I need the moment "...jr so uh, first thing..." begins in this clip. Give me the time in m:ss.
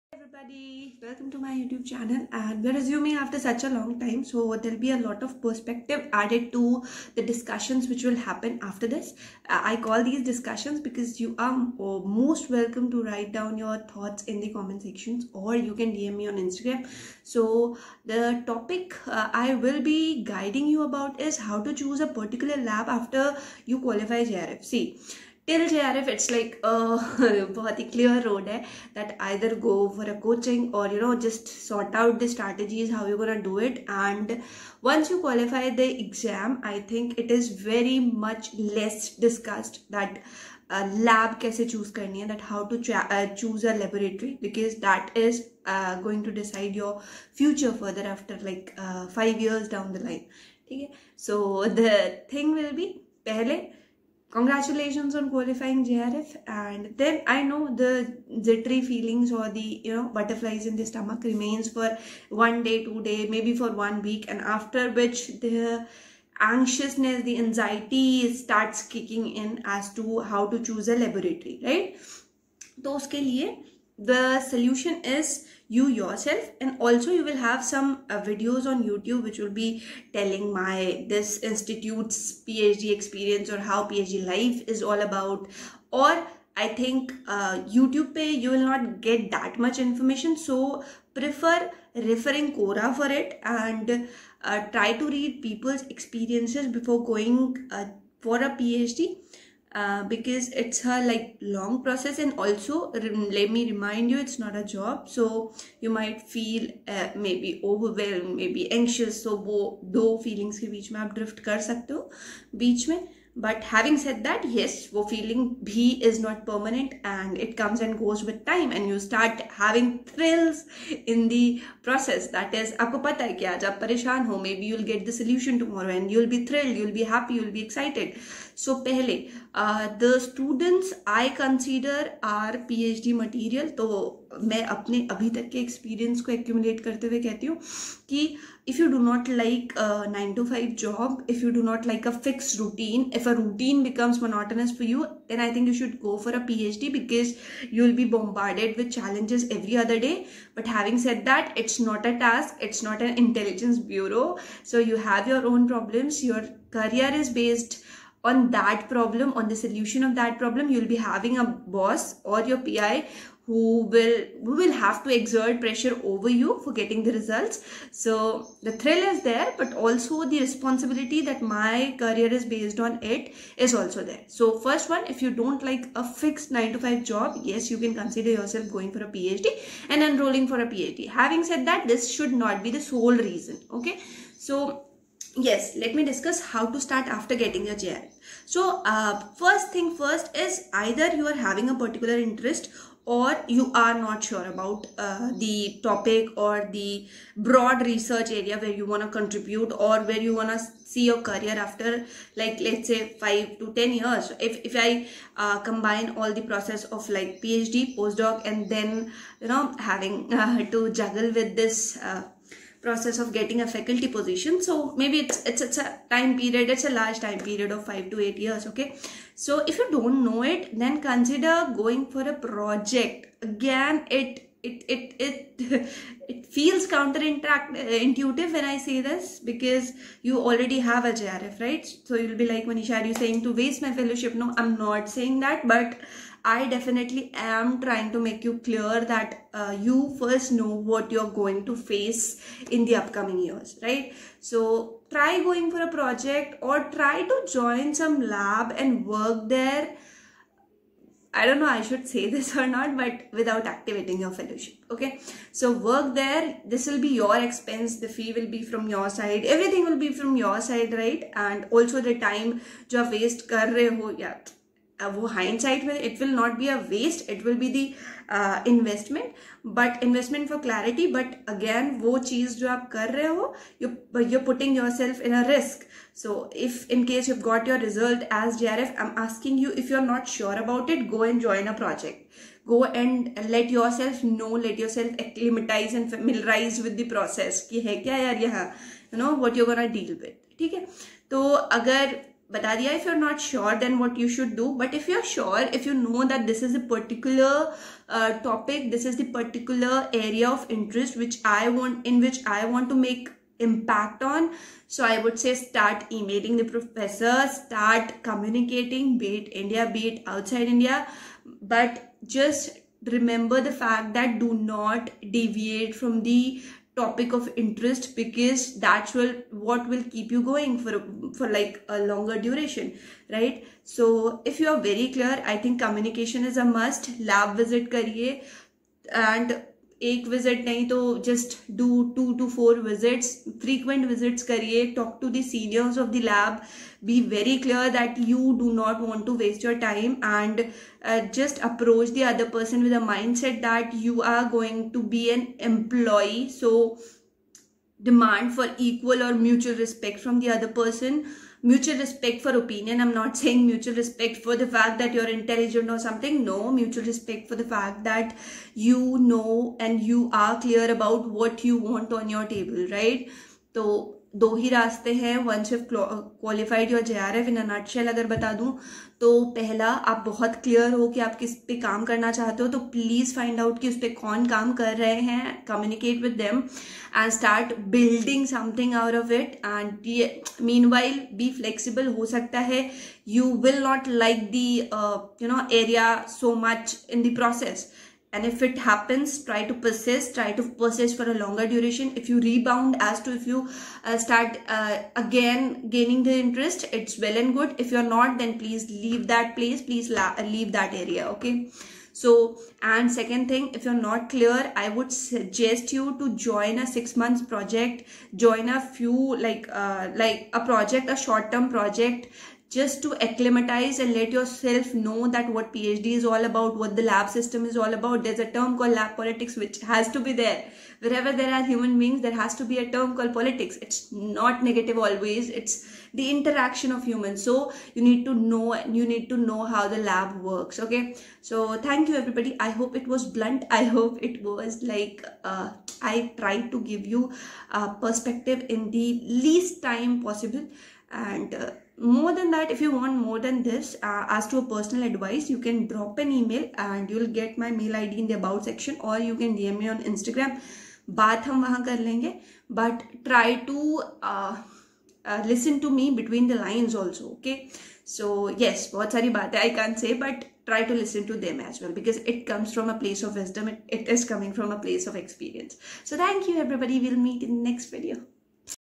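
3:07.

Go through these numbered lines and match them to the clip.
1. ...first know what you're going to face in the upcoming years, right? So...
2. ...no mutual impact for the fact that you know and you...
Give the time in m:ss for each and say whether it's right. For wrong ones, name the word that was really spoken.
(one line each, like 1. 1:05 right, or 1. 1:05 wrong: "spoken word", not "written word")
1. 4:00 right
2. 5:56 wrong: "respect", not "impact".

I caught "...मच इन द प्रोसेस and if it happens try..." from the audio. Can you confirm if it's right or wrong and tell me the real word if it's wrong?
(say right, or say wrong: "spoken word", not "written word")
right.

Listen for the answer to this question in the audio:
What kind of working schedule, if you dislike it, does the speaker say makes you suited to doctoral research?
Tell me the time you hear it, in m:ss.
2:20.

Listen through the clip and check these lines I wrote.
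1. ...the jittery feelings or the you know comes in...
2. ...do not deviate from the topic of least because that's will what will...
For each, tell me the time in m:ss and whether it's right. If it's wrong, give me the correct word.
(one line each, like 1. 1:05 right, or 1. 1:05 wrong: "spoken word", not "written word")
1. 0:57 wrong: "butterflies", not "comes"
2. 5:14 wrong: "interest", not "least".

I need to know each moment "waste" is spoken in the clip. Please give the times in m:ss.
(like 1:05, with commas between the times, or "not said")
3:53, 4:23.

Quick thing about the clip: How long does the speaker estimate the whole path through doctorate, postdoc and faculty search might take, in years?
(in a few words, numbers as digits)
5 to 8 years.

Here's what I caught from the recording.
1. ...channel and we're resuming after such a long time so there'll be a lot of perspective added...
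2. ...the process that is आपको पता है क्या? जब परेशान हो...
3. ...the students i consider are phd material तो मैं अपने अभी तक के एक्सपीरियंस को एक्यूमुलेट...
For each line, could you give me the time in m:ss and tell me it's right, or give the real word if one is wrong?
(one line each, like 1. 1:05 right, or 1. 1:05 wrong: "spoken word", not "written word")
1. 0:01 right
2. 2:01 right
3. 2:10 right.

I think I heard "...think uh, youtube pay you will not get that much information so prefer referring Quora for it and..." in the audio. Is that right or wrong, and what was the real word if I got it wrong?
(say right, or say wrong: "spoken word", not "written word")
right.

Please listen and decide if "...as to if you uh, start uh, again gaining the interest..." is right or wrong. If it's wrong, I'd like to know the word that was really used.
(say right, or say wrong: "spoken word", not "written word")
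right.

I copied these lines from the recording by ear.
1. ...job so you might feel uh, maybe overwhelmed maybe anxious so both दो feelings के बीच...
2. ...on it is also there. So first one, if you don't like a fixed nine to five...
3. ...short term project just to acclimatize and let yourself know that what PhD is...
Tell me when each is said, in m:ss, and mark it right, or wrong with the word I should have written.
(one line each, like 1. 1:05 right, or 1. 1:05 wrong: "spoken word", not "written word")
1. 1:44 right
2. 2:52 right
3. 6:51 right.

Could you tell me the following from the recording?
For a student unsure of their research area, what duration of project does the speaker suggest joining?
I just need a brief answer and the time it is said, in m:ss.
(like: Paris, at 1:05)
Six months, at 6:46.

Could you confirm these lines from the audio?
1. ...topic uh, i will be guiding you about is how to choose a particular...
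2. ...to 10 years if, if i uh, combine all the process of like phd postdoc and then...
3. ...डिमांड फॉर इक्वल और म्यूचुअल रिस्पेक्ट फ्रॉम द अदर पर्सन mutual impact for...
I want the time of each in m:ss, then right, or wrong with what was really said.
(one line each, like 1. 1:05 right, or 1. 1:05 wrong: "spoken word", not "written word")
1. 0:18 right
2. 3:23 right
3. 5:48 wrong: "respect", not "impact".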